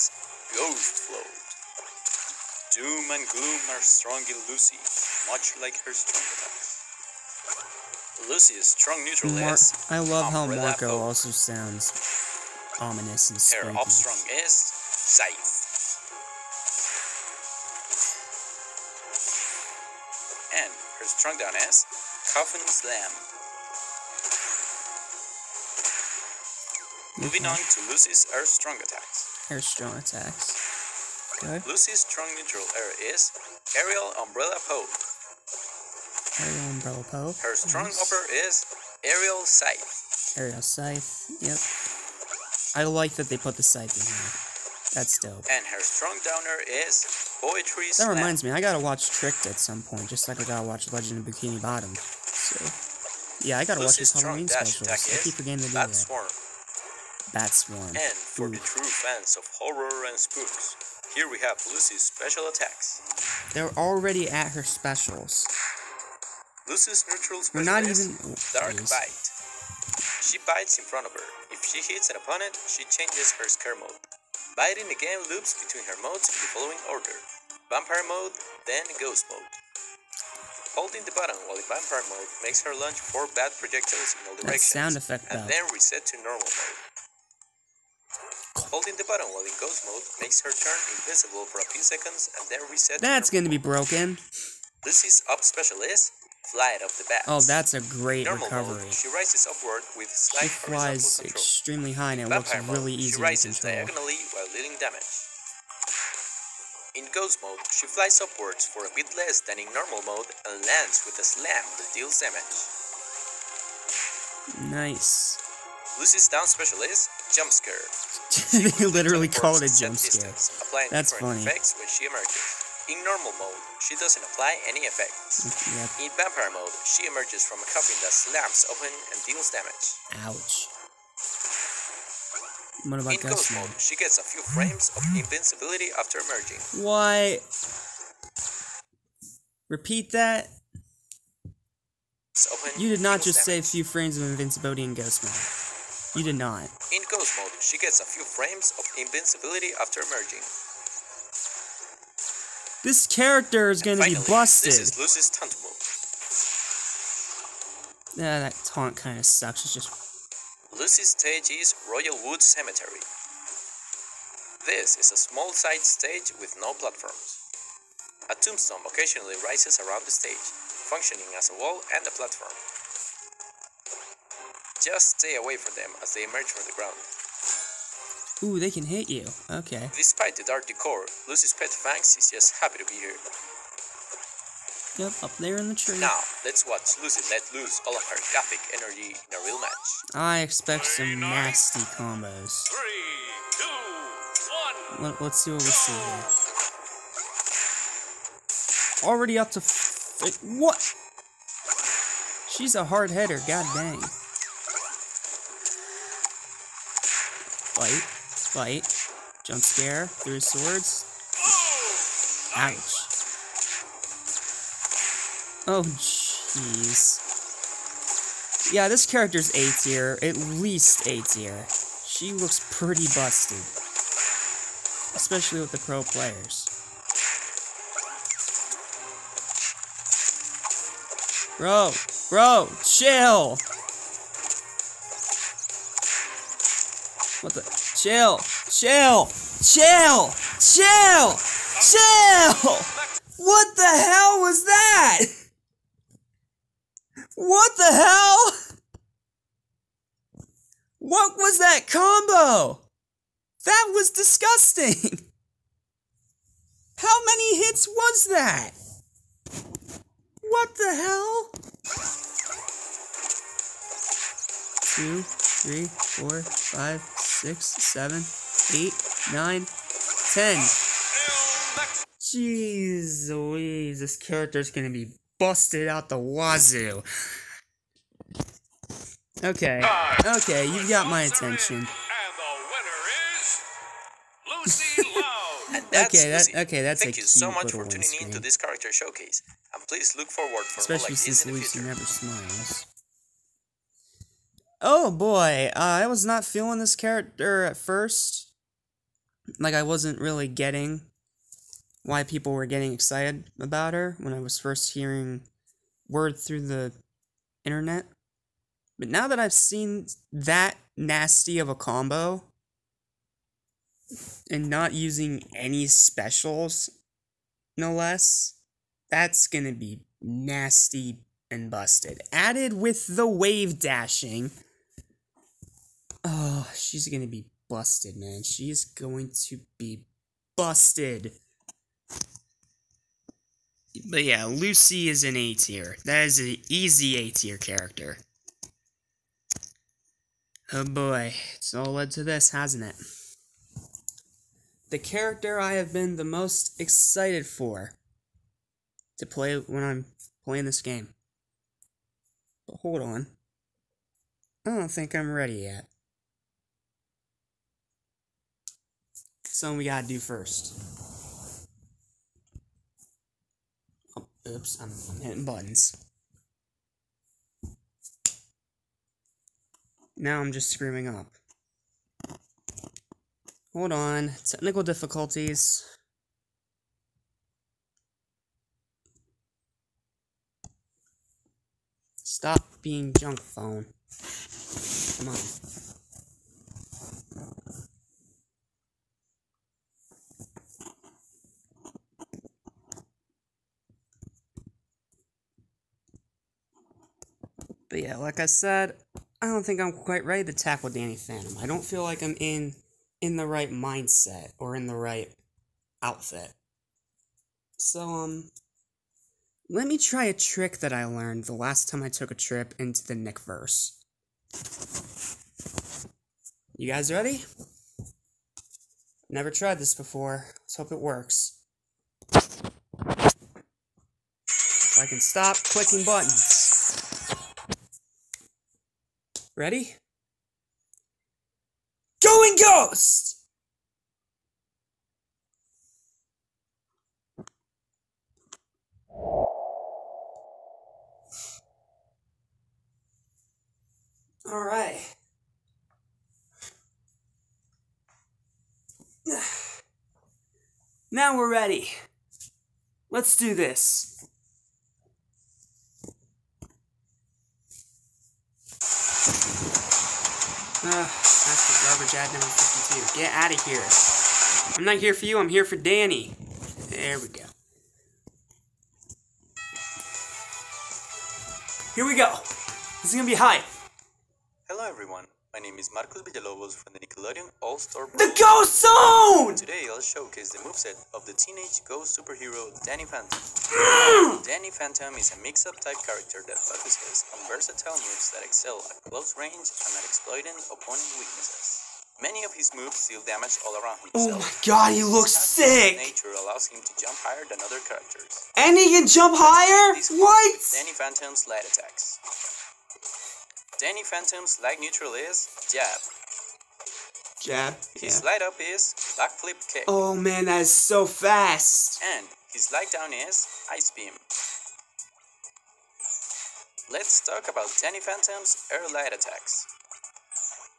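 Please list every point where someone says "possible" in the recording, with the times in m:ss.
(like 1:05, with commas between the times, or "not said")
not said.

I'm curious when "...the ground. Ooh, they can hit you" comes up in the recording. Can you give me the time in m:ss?
2:56.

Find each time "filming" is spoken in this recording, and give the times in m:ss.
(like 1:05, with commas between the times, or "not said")
not said.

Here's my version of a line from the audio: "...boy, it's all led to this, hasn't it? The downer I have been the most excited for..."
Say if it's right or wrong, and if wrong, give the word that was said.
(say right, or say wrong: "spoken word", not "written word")
wrong: "character", not "downer".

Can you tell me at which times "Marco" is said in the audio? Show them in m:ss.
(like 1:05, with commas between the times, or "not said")
0:10, 7:55.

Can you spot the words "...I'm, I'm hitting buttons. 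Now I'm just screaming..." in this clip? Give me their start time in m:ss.
6:04.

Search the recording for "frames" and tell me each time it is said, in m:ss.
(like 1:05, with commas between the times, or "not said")
2:14, 2:23, 2:28.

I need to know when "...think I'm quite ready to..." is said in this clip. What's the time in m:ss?
6:39.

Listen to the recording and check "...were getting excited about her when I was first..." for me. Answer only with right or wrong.
right.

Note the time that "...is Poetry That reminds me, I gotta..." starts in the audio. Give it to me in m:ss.
0:46.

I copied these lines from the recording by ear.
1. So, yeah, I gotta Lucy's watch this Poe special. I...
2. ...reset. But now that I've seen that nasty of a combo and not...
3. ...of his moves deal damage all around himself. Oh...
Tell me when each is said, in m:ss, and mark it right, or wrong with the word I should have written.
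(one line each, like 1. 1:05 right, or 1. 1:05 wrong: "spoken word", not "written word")
1. 0:51 wrong: "Halloween", not "Poe"
2. 5:07 wrong: "internet", not "reset"
3. 8:12 right.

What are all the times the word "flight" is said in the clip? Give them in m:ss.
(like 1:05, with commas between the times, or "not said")
1:36.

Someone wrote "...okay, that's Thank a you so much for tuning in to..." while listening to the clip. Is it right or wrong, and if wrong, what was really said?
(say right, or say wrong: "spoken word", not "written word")
right.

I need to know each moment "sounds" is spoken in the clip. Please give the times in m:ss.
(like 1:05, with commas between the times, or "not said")
0:11, 1:24.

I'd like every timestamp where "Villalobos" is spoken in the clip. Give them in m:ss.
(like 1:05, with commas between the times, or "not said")
7:56.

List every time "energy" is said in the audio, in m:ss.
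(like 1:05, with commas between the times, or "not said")
3:08.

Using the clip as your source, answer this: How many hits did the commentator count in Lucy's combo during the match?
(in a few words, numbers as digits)
10.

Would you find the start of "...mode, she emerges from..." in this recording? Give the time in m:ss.
2:06.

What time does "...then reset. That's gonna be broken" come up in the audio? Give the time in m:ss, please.
1:32.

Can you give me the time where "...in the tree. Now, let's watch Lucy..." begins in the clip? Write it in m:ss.
3:05.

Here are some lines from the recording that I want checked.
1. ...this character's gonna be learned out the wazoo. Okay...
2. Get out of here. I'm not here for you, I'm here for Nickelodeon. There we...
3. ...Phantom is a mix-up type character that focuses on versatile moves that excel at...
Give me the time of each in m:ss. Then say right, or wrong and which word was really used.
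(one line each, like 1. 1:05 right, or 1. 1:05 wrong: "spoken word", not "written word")
1. 4:33 wrong: "busted", not "learned"
2. 7:43 wrong: "Danny", not "Nickelodeon"
3. 8:04 right.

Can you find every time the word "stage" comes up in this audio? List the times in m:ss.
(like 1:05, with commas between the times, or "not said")
2:41, 2:45, 2:50.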